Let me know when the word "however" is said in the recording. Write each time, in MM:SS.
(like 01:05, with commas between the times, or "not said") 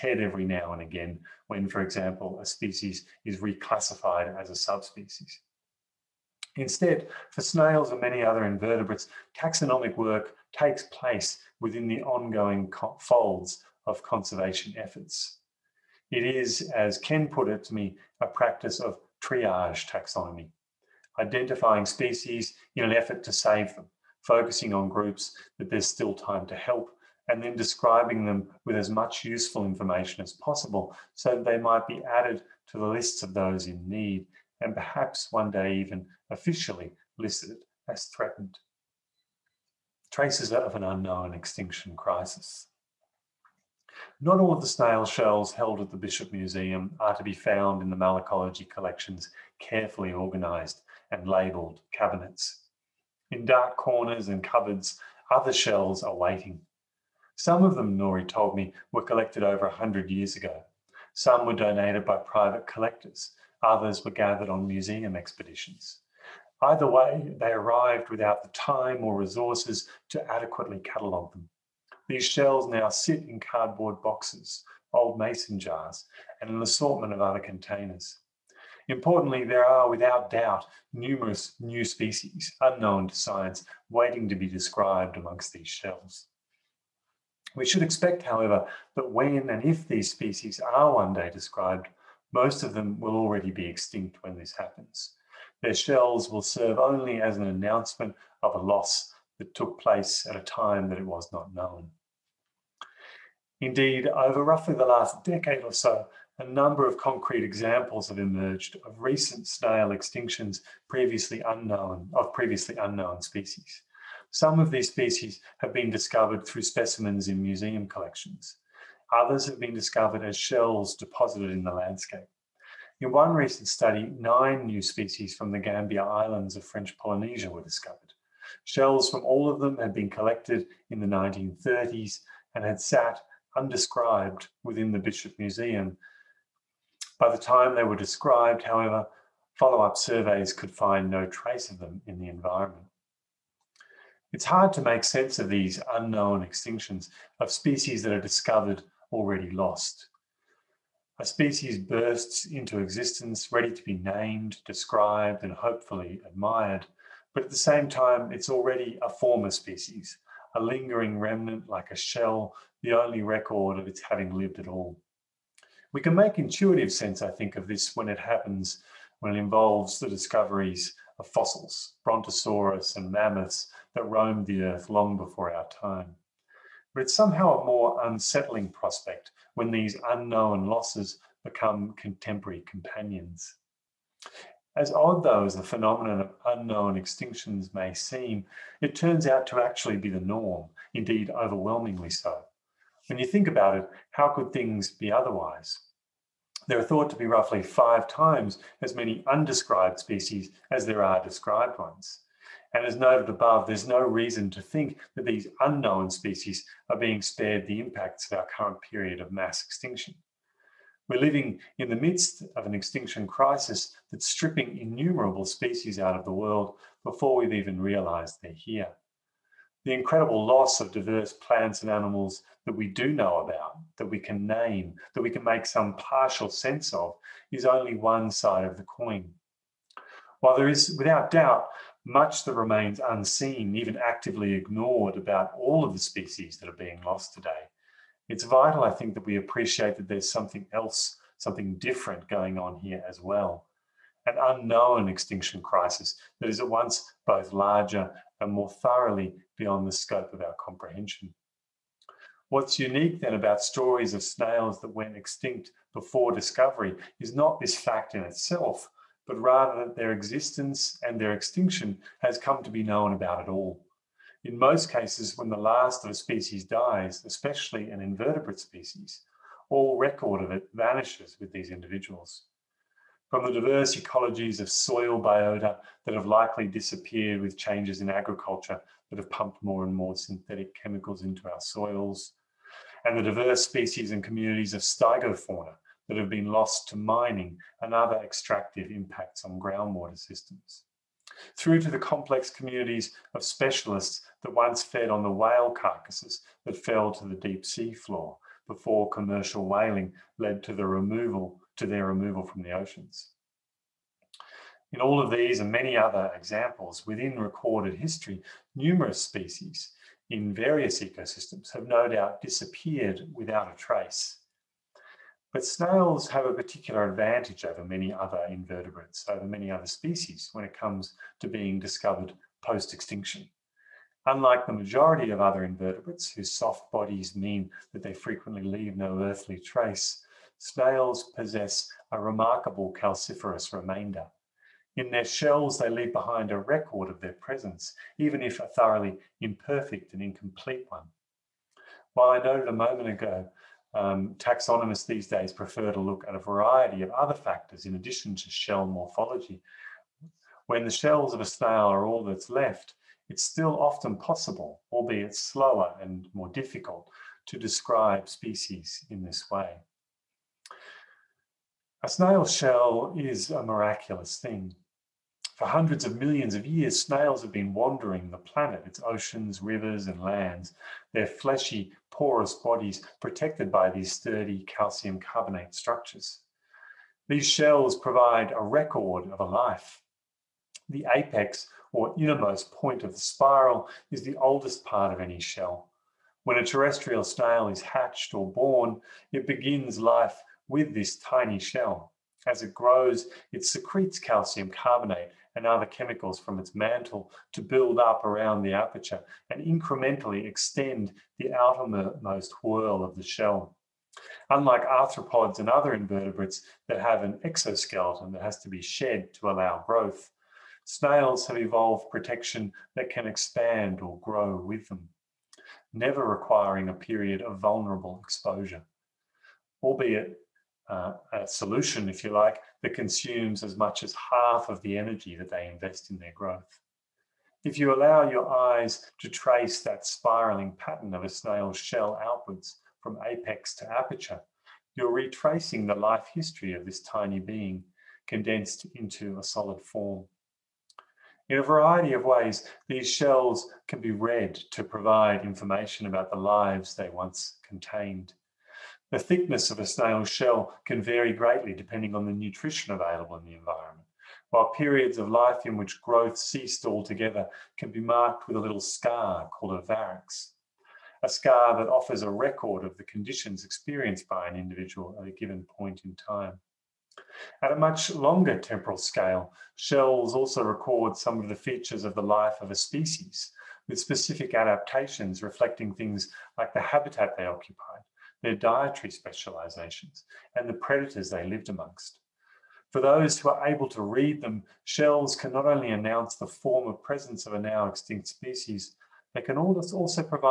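01:28, 02:18.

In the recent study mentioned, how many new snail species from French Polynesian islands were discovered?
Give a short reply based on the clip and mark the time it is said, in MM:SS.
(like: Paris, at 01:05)
9, at 02:04.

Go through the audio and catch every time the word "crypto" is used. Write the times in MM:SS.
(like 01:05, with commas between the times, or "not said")
not said.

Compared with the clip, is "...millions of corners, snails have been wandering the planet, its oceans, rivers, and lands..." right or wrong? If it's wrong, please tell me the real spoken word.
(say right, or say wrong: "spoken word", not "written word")
wrong: "years", not "corners".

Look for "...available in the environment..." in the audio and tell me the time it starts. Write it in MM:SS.
07:32.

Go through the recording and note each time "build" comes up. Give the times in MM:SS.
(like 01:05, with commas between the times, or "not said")
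06:37.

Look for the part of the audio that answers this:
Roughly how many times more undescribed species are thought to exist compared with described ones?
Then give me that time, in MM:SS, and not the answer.
03:17.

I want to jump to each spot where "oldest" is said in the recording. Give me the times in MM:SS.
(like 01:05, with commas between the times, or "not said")
06:24.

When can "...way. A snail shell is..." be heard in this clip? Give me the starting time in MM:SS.
05:59.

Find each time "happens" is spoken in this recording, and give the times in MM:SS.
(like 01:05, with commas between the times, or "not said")
01:34, 02:48.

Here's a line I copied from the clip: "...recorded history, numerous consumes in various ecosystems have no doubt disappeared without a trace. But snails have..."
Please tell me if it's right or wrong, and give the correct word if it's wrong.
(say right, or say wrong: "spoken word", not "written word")
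wrong: "species", not "consumes".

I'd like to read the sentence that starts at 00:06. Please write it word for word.
Instead, for snails and many other invertebrates, taxonomic work takes place within the ongoing folds of conservation efforts.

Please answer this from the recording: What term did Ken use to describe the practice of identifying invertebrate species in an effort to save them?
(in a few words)
triage taxonomy.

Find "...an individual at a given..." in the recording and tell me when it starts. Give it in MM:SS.
07:44.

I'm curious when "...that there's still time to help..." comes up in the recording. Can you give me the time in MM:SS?
00:25.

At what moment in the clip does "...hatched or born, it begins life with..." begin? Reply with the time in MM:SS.
06:27.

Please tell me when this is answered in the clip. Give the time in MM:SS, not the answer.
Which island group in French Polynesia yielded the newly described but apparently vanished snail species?
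02:05.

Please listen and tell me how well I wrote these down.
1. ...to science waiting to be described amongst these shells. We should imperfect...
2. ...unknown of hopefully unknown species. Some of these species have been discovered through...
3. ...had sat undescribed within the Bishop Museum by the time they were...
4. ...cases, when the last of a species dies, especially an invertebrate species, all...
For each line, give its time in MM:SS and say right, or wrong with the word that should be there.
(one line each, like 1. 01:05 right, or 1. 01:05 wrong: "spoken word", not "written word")
1. 01:23 wrong: "expect", not "imperfect"
2. 01:51 wrong: "previously", not "hopefully"
3. 02:12 right
4. 04:24 right.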